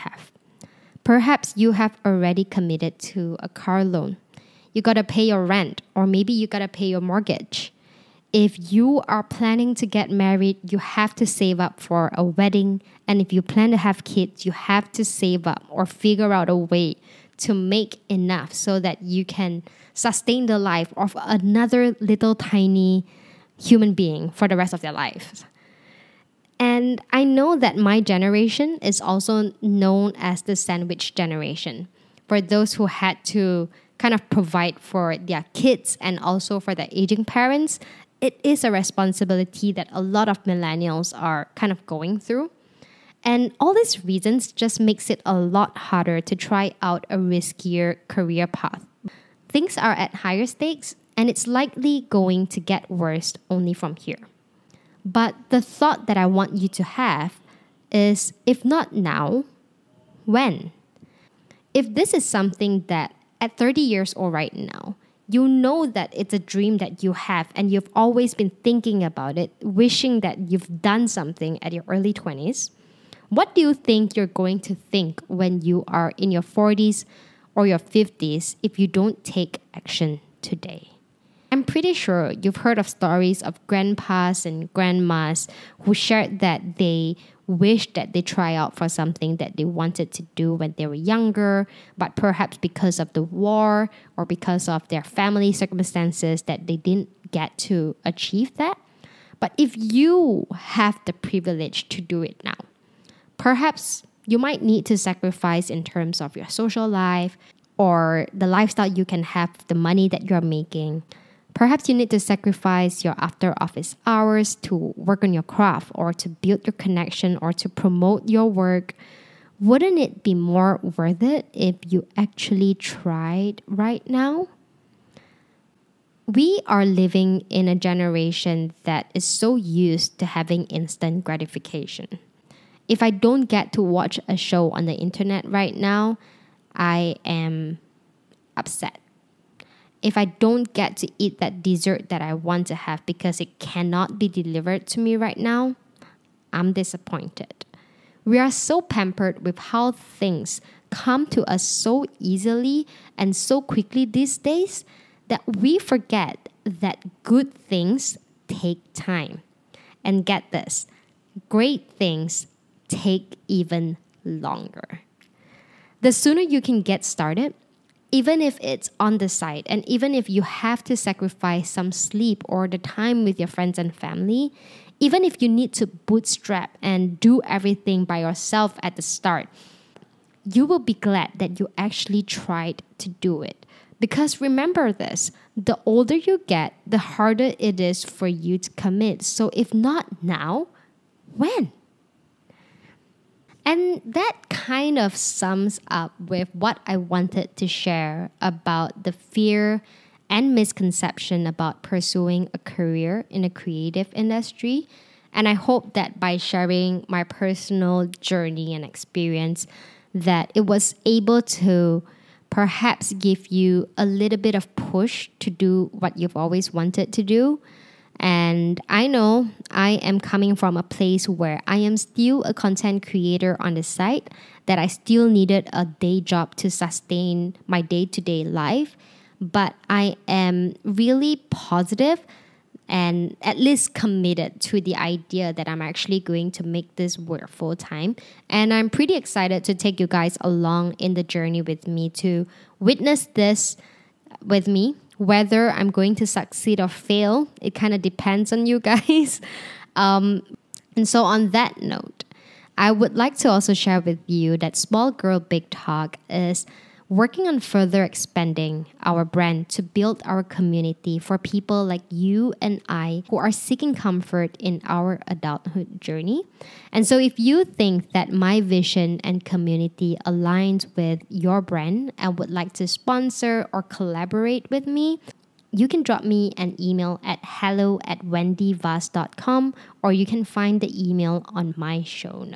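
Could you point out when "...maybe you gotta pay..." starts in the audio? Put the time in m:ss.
0:06.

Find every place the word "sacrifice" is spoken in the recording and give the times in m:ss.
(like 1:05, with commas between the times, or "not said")
1:44, 1:52, 2:50.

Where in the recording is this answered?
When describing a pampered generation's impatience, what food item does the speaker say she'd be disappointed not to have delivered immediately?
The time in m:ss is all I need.
2:21.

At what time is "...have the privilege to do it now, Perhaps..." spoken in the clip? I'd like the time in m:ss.
1:40.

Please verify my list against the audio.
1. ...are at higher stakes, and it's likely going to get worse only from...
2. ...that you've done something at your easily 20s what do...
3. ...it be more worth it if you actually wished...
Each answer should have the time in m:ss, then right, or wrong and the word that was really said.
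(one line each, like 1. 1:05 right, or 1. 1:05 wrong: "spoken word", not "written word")
1. 0:49 right
2. 1:10 wrong: "early", not "easily"
3. 1:59 wrong: "tried", not "wished".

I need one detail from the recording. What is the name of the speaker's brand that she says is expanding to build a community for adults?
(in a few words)
Small Girl Big Talk.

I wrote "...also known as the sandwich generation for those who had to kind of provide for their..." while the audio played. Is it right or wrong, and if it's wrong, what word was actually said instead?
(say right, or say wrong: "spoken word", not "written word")
right.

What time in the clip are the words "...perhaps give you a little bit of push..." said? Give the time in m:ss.
3:32.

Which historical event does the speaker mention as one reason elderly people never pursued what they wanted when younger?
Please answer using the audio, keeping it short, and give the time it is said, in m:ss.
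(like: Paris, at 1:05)
the war, at 1:33.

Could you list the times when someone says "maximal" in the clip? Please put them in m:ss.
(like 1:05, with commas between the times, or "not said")
not said.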